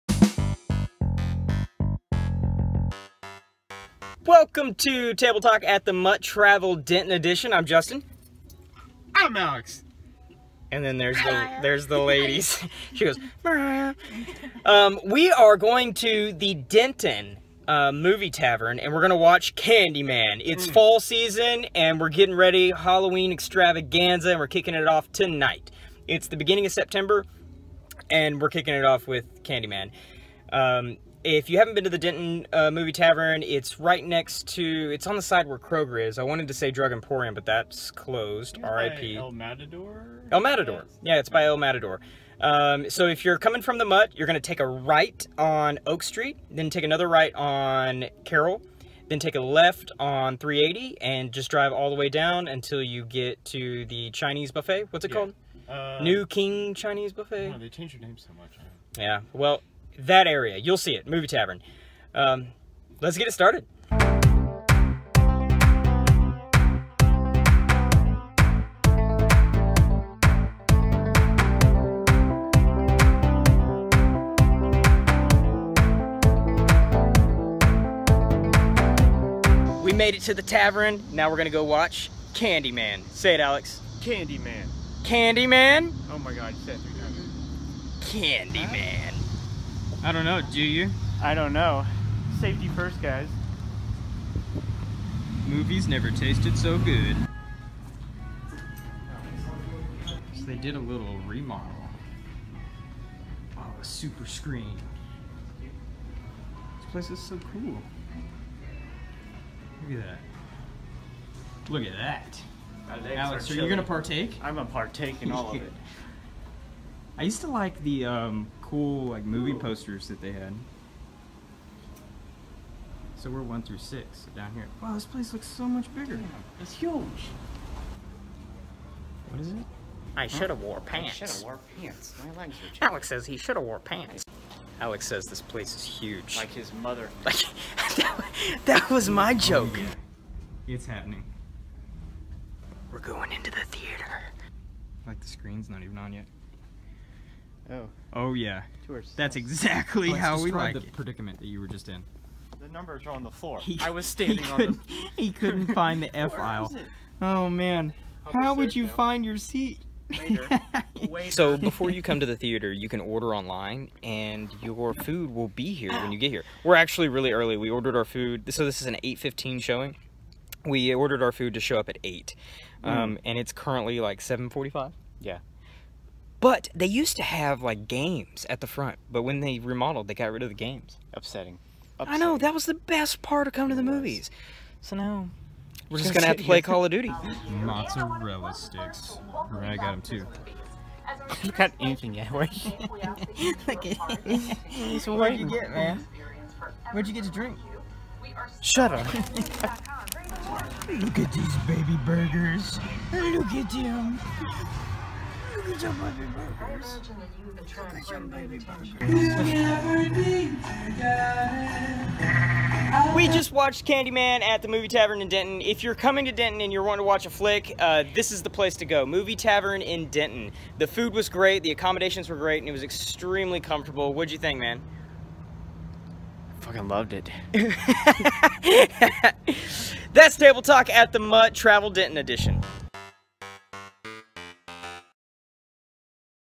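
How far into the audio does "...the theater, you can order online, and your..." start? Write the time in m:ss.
2:42.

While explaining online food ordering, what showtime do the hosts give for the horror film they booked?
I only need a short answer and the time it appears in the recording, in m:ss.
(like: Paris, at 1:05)
8:15, at 2:49.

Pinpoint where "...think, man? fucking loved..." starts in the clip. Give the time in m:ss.
3:44.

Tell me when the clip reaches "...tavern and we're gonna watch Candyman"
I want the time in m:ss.
0:18.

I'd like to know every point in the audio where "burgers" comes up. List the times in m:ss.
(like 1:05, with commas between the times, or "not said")
3:22.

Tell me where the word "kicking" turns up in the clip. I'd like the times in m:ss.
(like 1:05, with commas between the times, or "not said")
0:24, 0:28.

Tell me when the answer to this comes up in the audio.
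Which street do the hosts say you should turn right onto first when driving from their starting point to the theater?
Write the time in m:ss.
0:45.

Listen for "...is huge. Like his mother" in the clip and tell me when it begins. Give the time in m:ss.
2:15.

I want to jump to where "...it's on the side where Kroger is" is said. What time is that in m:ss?
0:34.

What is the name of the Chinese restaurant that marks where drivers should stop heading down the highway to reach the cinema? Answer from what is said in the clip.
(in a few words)
New King Chinese Buffet.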